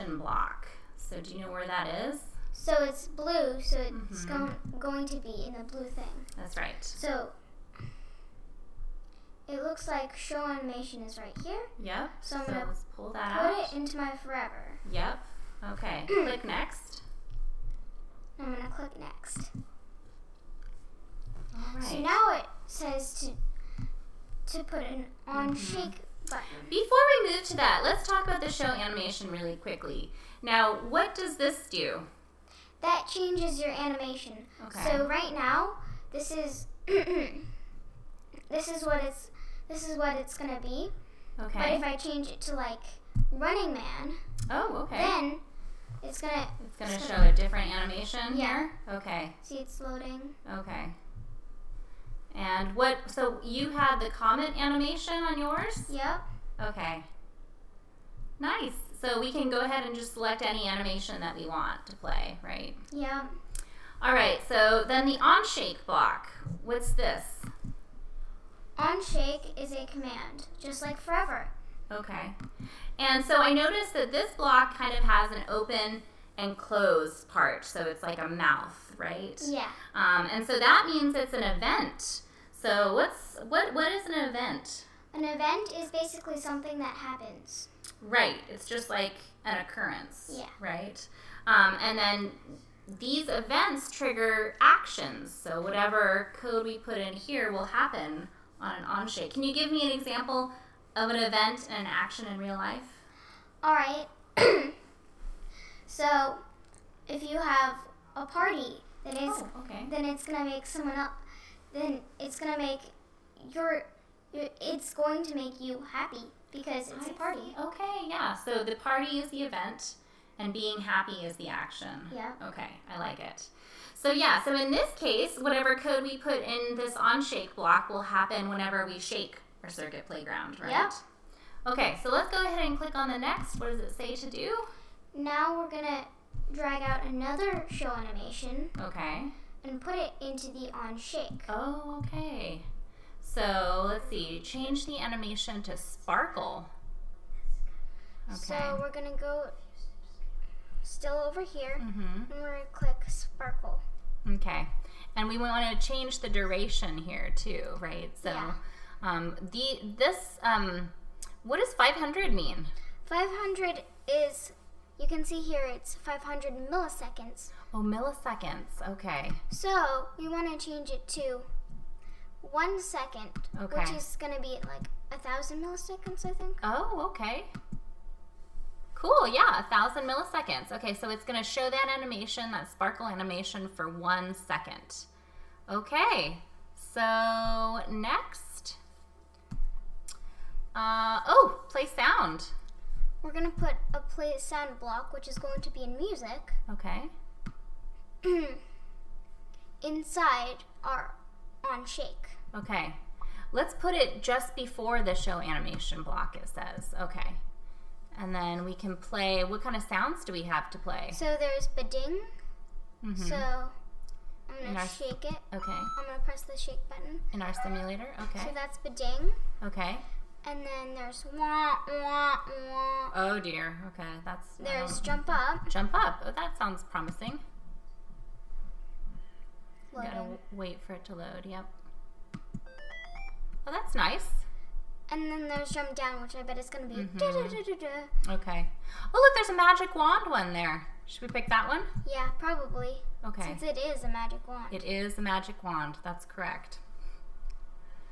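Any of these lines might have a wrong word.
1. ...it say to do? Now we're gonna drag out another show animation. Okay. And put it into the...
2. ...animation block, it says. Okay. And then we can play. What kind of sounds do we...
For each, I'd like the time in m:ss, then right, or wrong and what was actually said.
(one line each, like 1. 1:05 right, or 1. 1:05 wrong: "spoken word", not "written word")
1. 2:13 right
2. 3:25 right.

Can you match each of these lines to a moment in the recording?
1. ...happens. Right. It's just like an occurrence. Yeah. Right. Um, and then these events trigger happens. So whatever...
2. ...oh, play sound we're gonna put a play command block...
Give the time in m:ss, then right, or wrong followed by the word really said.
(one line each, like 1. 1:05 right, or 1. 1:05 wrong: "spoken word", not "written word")
1. 1:26 wrong: "actions", not "happens"
2. 3:11 wrong: "sound", not "command".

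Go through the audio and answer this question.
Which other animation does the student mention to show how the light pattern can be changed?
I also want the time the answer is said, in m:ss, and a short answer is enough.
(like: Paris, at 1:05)
Running Man, at 0:43.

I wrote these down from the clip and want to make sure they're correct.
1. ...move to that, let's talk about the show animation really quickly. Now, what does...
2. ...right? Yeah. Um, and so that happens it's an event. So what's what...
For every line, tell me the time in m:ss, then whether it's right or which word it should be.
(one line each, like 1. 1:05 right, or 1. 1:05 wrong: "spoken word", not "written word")
1. 0:27 right
2. 1:18 wrong: "means", not "happens".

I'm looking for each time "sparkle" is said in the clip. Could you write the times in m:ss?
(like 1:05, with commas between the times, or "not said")
2:25, 2:33, 3:02.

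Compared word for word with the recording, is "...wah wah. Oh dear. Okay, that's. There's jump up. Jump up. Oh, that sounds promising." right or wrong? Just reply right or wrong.
right.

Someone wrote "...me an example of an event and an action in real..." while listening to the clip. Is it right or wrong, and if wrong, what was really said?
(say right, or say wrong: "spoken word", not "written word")
right.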